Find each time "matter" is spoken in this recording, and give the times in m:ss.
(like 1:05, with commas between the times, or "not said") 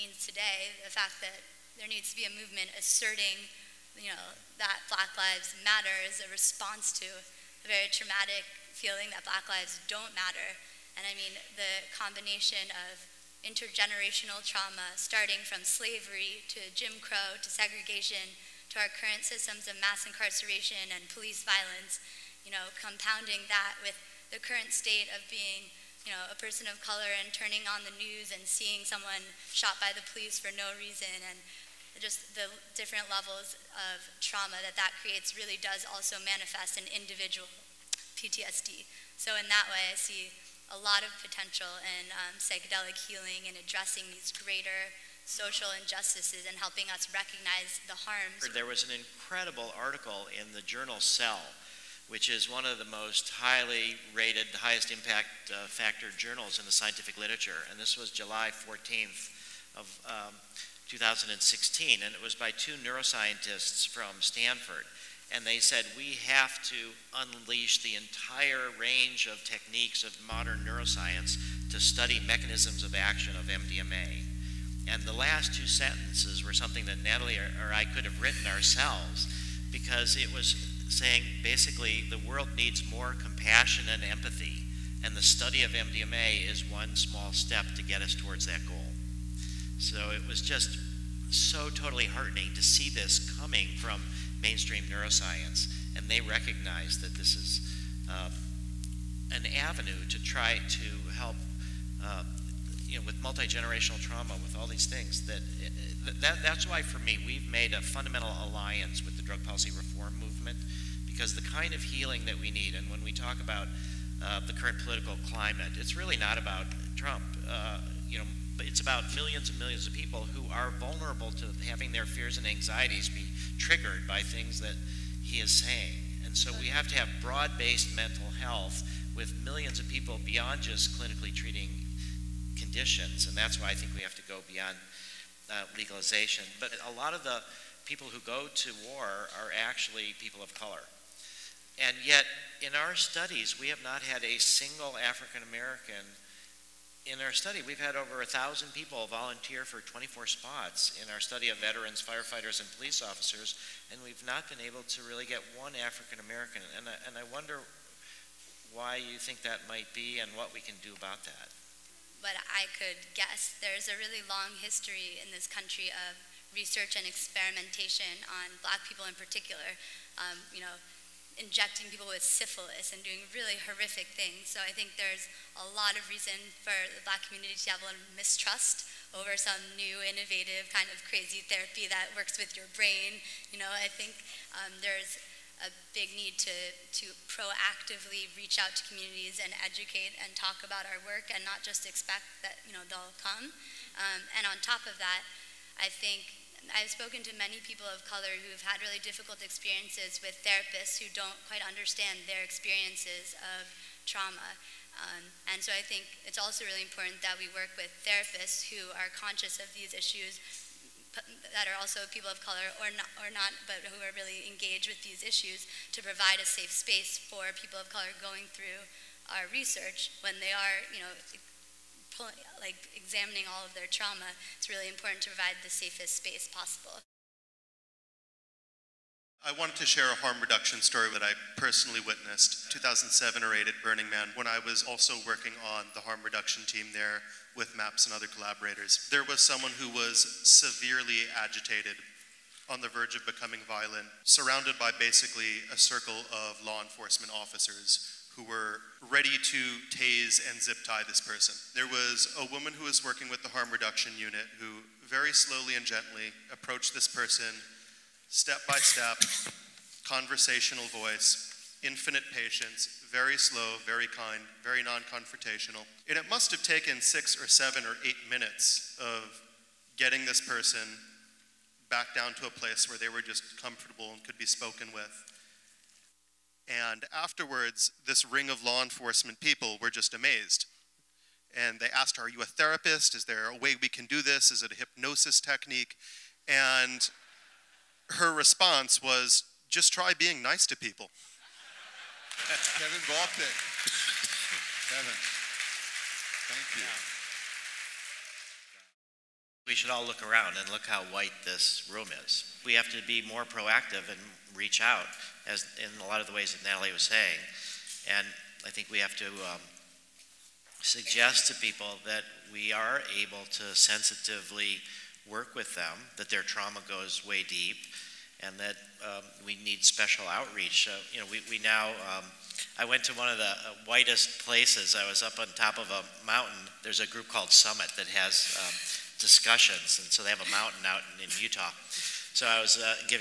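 0:05, 0:10.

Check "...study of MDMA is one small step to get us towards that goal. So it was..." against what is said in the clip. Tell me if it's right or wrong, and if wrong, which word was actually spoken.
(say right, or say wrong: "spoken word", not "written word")
right.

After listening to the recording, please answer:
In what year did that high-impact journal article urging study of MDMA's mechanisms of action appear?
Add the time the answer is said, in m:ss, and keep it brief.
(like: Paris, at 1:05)
2016, at 1:00.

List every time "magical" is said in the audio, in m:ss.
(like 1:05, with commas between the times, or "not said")
not said.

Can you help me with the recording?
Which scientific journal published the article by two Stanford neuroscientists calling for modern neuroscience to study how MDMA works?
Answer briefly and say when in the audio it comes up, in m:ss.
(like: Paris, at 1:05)
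Cell, at 0:50.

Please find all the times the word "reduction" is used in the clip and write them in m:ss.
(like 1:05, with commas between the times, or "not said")
3:50, 3:56, 4:13.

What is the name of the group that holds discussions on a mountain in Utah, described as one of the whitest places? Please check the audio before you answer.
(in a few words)
Summit.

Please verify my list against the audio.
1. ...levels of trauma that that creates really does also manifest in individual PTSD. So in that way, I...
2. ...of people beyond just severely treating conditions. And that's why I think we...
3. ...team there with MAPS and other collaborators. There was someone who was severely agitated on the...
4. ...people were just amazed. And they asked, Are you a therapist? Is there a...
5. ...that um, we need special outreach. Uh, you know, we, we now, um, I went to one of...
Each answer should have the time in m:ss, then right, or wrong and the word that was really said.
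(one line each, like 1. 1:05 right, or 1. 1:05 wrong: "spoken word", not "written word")
1. 0:33 right
2. 2:09 wrong: "clinically", not "severely"
3. 3:56 right
4. 4:39 right
5. 5:18 right.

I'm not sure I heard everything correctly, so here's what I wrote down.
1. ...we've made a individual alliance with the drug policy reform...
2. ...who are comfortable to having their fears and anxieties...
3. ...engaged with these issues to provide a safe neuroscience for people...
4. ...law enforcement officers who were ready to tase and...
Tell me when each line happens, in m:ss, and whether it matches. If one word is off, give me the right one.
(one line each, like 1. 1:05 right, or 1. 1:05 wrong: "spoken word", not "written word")
1. 1:47 wrong: "fundamental", not "individual"
2. 2:00 wrong: "vulnerable", not "comfortable"
3. 3:34 wrong: "space", not "neuroscience"
4. 4:06 right.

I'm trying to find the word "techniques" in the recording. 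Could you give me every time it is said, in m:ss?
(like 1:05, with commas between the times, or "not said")
1:09, 4:45.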